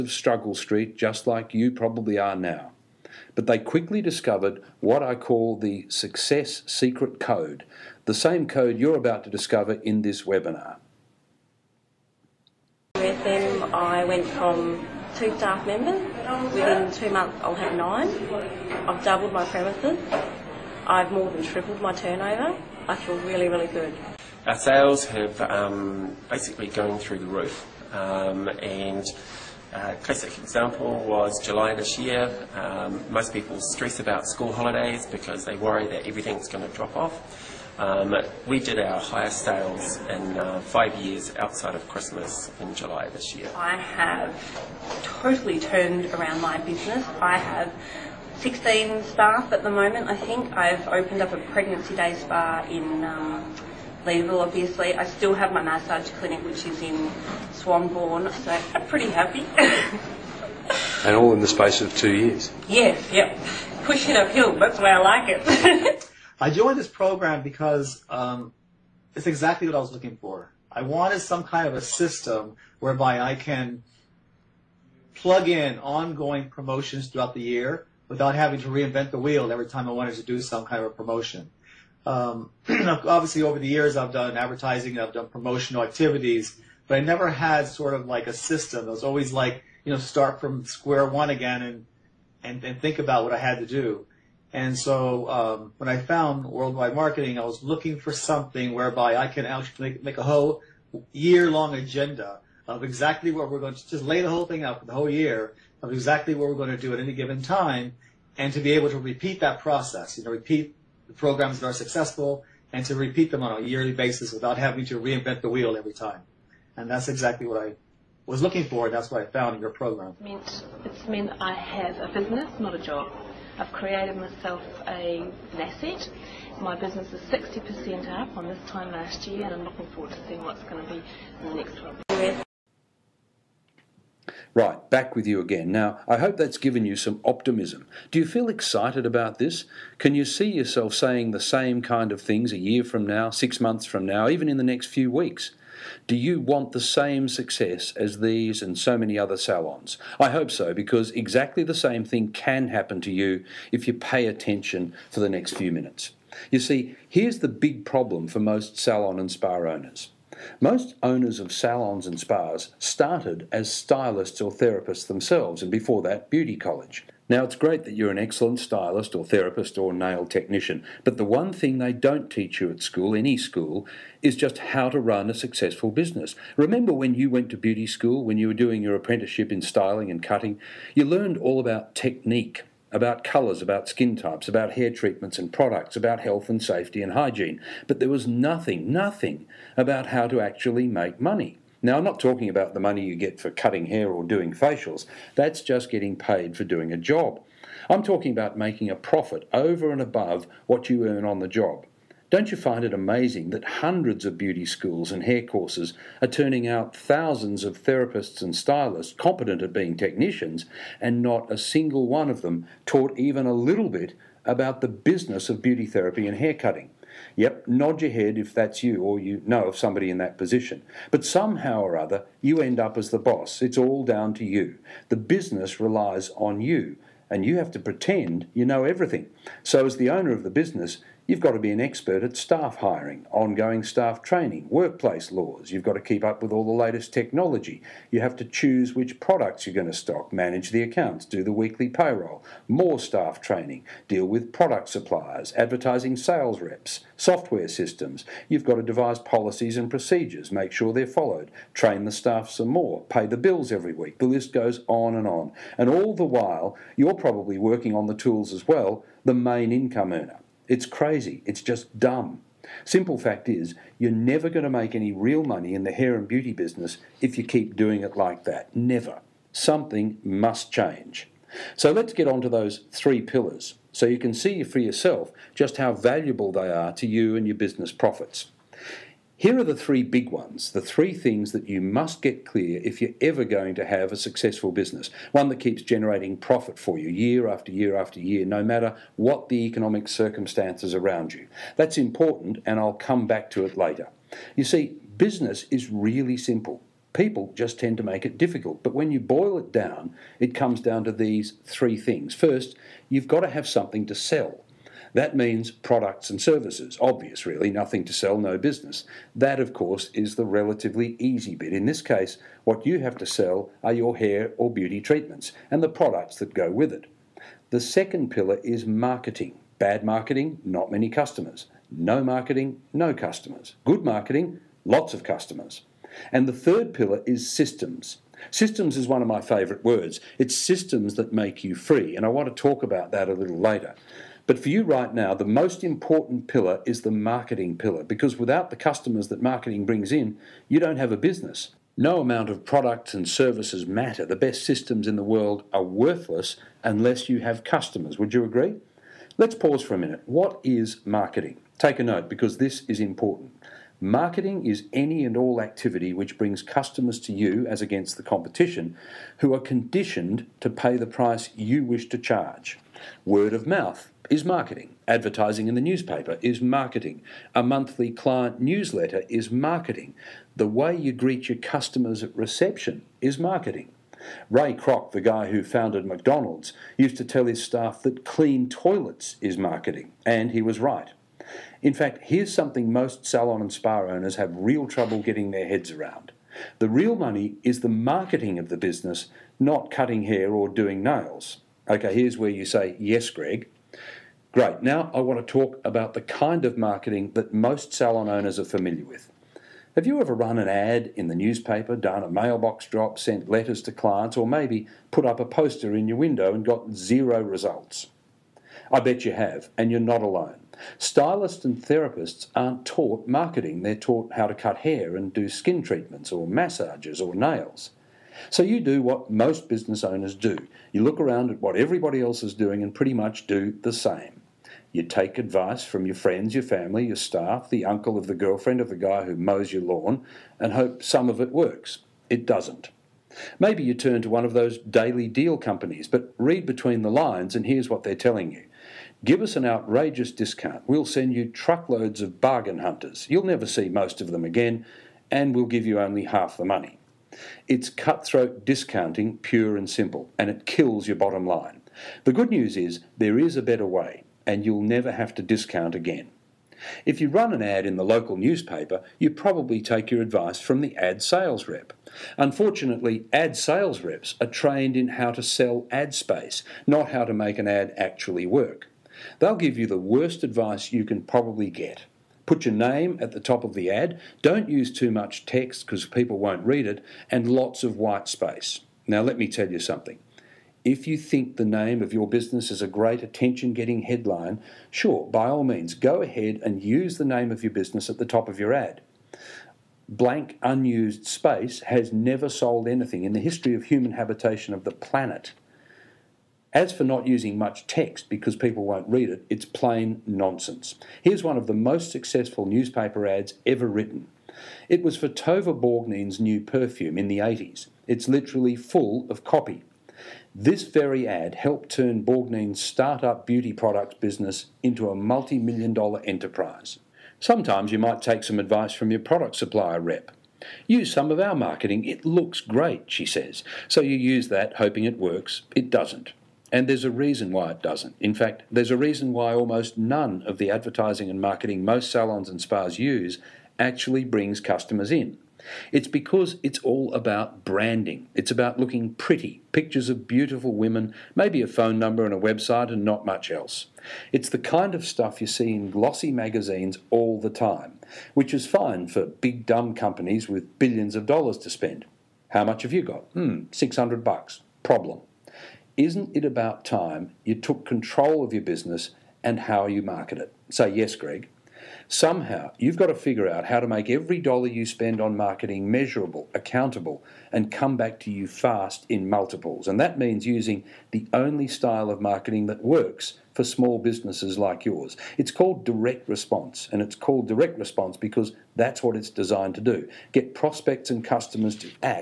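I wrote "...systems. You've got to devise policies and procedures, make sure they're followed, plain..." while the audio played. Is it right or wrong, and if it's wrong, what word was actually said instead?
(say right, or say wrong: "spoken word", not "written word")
wrong: "train", not "plain".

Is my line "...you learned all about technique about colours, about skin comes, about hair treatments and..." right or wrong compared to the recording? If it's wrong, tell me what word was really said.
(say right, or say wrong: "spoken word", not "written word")
wrong: "types", not "comes".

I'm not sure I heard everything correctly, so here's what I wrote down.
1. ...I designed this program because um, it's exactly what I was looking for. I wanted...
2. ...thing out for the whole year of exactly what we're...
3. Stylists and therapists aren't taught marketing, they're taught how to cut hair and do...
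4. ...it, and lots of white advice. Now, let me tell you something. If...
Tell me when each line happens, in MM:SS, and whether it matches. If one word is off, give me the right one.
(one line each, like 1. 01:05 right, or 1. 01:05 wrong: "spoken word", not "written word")
1. 01:06 wrong: "joined", not "designed"
2. 01:44 right
3. 06:50 right
4. 07:56 wrong: "space", not "advice".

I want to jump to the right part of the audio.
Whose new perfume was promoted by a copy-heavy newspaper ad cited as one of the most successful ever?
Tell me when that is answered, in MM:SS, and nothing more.
08:25.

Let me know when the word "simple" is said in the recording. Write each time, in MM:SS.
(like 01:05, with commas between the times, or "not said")
04:22, 04:56, 07:29.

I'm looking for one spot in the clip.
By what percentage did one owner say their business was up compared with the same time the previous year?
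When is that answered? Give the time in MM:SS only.
02:07.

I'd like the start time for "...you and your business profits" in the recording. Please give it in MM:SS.
04:37.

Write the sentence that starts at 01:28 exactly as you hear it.
It was always like, you know, start from square one again and, and, and think about what I had to do.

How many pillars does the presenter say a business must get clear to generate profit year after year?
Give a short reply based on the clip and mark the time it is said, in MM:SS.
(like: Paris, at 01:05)
3, at 04:32.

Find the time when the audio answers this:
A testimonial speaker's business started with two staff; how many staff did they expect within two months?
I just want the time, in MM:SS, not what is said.
00:17.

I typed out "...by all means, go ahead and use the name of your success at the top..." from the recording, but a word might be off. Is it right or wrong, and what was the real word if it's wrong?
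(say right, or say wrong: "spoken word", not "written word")
wrong: "business", not "success".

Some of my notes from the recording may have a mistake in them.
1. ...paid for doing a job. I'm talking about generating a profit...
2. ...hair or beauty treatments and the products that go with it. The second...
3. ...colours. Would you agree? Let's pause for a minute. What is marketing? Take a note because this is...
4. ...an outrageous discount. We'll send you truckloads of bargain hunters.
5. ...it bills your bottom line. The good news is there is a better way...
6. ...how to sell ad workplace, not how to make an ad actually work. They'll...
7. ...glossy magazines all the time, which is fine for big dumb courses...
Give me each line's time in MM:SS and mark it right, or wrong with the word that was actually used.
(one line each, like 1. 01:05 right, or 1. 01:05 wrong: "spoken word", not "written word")
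1. 03:16 wrong: "making", not "generating"
2. 05:14 right
3. 05:47 wrong: "customers", not "colours"
4. 07:19 right
5. 07:30 wrong: "kills", not "bills"
6. 07:45 wrong: "space", not "workplace"
7. 09:05 wrong: "companies", not "courses".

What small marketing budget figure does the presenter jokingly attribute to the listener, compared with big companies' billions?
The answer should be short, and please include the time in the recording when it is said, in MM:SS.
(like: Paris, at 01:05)
$600, at 09:13.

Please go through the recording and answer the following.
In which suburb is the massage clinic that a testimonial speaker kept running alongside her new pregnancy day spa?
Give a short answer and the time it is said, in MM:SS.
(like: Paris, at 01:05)
Swanbourne, at 00:57.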